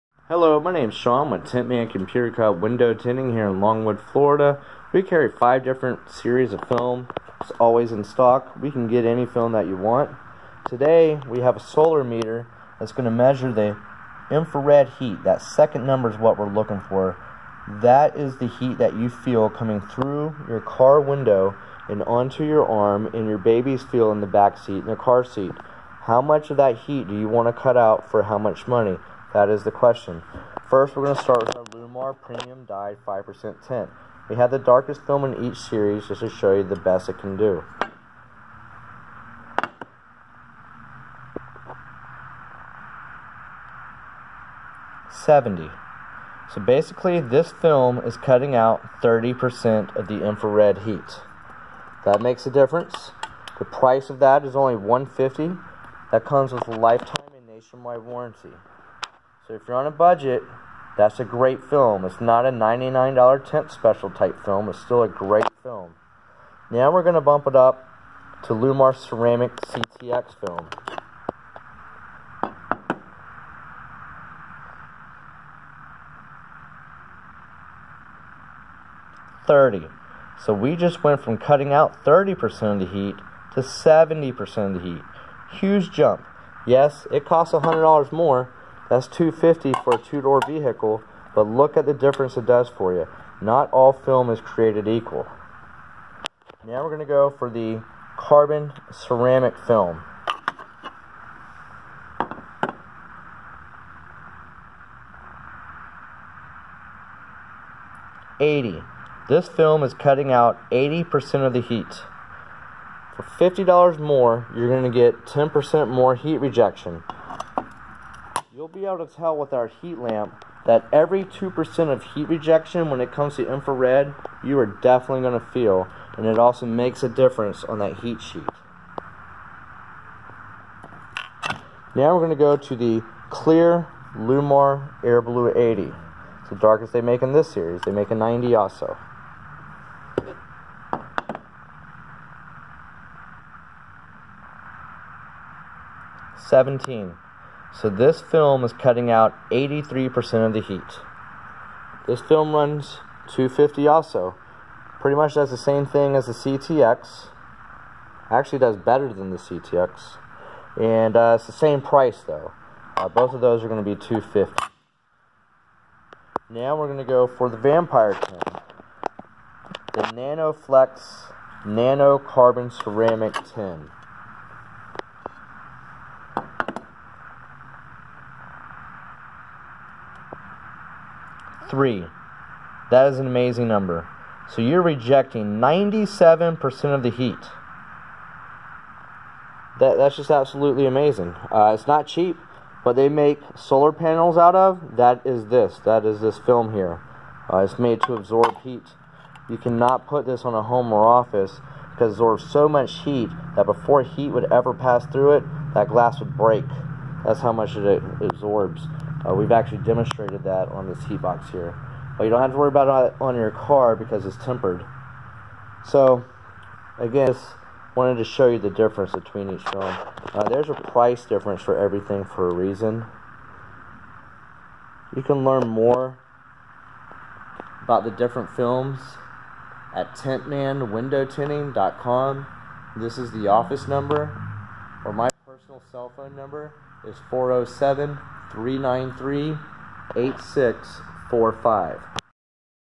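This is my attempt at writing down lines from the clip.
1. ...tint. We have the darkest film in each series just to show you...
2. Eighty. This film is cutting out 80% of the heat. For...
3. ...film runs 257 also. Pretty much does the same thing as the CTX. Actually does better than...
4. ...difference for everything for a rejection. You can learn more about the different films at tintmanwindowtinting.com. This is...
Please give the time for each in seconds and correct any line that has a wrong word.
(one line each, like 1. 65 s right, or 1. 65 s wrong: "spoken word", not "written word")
1. 33 s right
2. 108 s right
3. 152 s wrong: "250", not "257"
4. 221 s wrong: "reason", not "rejection".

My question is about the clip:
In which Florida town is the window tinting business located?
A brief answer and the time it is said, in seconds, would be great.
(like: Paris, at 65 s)
Longwood, at 3 s.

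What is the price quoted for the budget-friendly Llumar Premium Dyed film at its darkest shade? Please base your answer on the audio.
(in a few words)
$150.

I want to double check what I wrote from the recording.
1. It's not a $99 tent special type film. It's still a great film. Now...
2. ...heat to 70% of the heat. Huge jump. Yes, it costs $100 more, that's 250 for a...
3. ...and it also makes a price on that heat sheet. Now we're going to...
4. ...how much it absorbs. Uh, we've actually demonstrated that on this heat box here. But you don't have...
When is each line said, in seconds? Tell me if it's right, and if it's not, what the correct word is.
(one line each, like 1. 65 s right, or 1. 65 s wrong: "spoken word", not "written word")
1. 62 s right
2. 82 s right
3. 126 s wrong: "difference", not "price"
4. 207 s right.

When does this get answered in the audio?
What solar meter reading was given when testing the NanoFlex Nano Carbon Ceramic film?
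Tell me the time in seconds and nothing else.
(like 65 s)
181 s.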